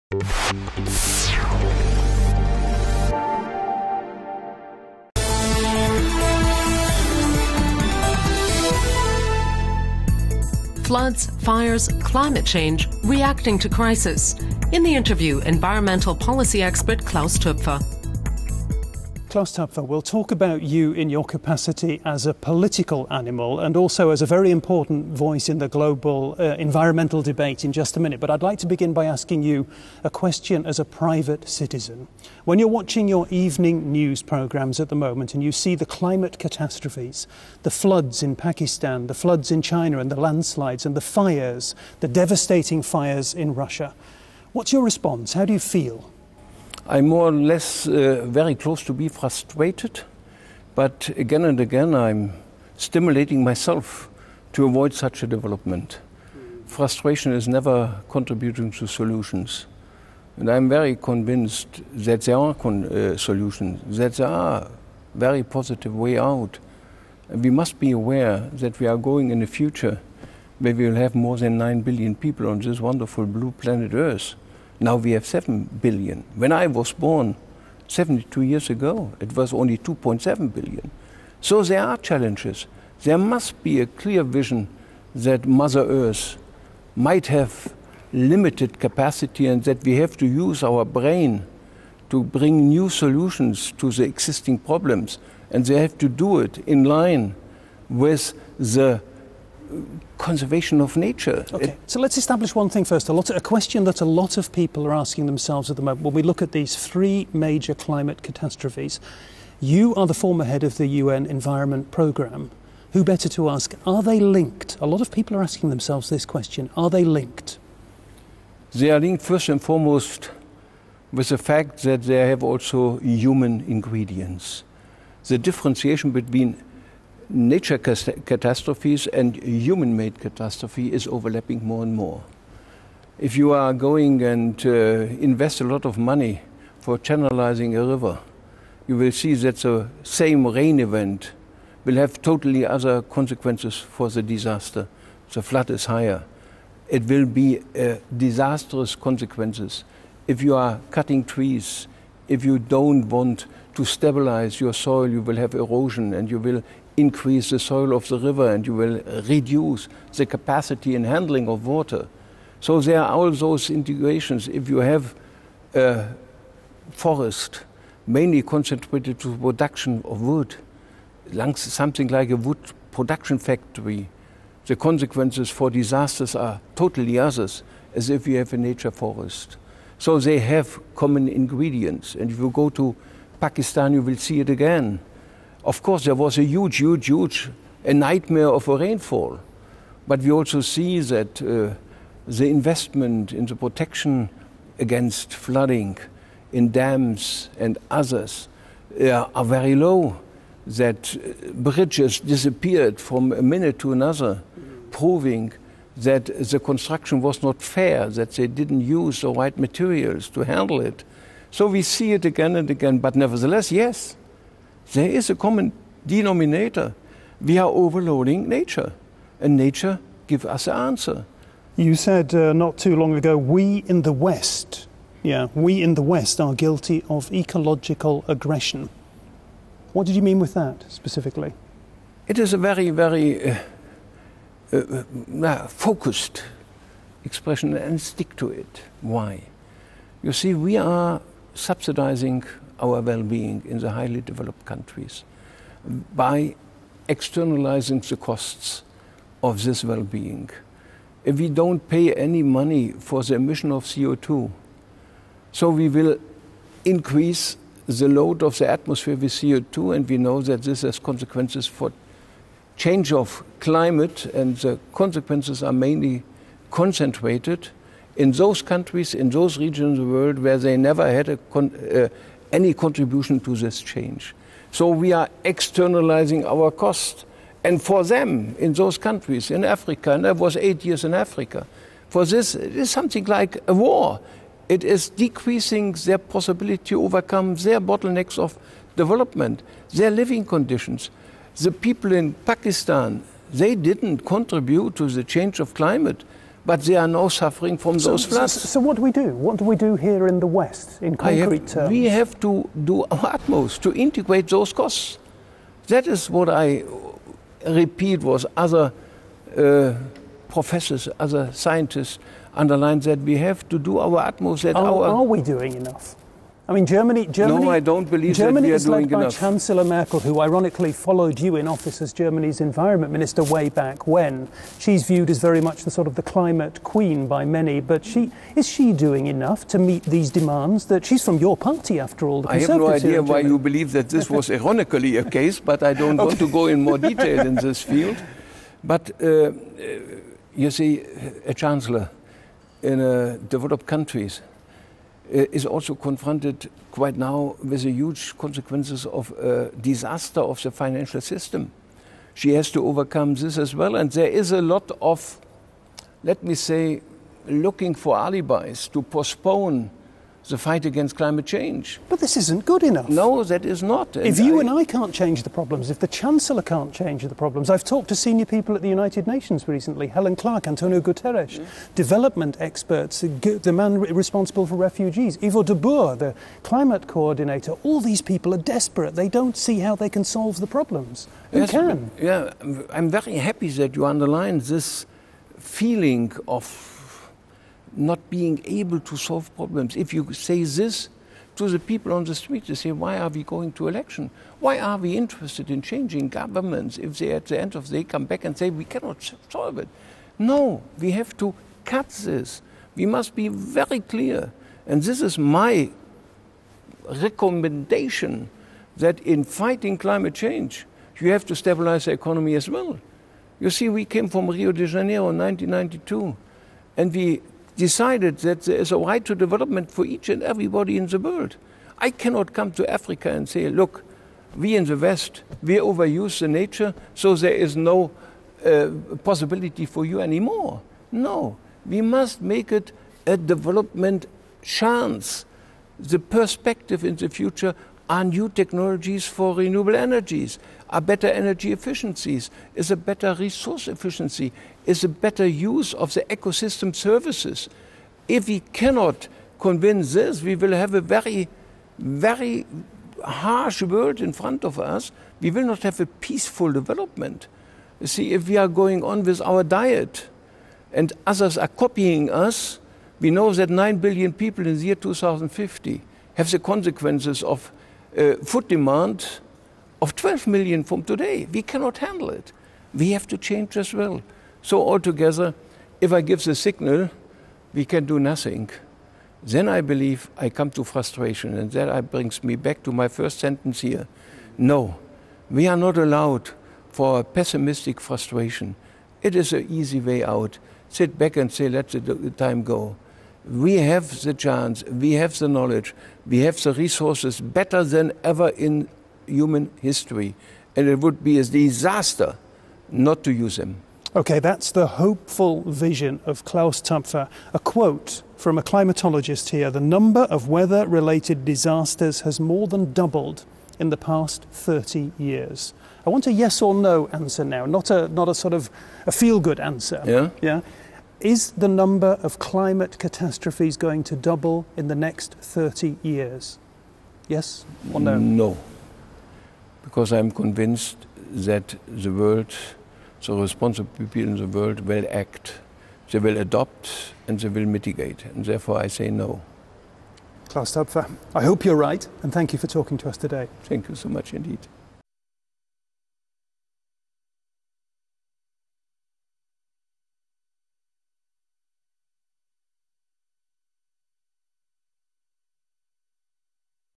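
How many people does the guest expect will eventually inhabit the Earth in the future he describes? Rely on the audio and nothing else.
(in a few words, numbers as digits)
more than 9 billion.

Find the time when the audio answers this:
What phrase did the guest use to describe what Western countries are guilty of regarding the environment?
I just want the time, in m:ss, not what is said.
3:47.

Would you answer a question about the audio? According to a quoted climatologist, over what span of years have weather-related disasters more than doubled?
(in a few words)
30 years.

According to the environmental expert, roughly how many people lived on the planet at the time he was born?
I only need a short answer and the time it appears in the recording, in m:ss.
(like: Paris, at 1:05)
2.7 billion, at 1:19.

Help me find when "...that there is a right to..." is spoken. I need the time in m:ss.
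6:58.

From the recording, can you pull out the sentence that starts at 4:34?
So we are externalizing our cost.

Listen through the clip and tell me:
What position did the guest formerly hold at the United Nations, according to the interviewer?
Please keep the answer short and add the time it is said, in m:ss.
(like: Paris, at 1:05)
head of the UN Environment Programme, at 1:50.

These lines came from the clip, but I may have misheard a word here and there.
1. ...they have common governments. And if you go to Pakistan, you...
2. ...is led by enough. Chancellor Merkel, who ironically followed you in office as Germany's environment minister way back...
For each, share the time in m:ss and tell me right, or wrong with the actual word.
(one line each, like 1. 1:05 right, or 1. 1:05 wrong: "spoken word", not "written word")
1. 3:00 wrong: "ingredients", not "governments"
2. 5:18 right.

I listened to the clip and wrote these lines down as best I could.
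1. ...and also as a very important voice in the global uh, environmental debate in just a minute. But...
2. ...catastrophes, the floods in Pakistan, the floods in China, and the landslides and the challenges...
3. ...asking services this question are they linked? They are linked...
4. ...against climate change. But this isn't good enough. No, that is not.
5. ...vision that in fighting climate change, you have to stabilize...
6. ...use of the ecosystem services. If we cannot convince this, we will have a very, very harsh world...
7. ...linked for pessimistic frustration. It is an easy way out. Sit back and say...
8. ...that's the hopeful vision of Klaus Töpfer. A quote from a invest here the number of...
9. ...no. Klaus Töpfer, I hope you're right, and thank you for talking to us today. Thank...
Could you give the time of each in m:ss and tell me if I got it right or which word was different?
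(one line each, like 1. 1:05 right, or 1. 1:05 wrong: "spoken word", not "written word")
1. 0:23 right
2. 0:36 wrong: "fires", not "challenges"
3. 1:55 wrong: "themselves", not "services"
4. 6:00 right
5. 6:47 wrong: "recommendation", not "vision"
6. 7:25 right
7. 8:05 wrong: "allowed", not "linked"
8. 8:24 wrong: "climatologist", not "invest"
9. 8:59 right.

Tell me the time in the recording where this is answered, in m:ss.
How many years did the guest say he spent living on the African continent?
4:40.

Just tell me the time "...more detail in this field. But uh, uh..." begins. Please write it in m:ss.
5:36.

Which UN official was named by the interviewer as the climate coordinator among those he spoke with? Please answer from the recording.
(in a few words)
Yvo de Boer.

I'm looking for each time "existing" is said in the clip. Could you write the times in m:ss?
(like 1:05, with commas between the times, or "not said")
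1:34.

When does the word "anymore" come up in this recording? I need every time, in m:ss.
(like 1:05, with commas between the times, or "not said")
7:10.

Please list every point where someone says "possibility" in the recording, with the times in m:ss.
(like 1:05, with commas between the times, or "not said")
4:46, 7:09.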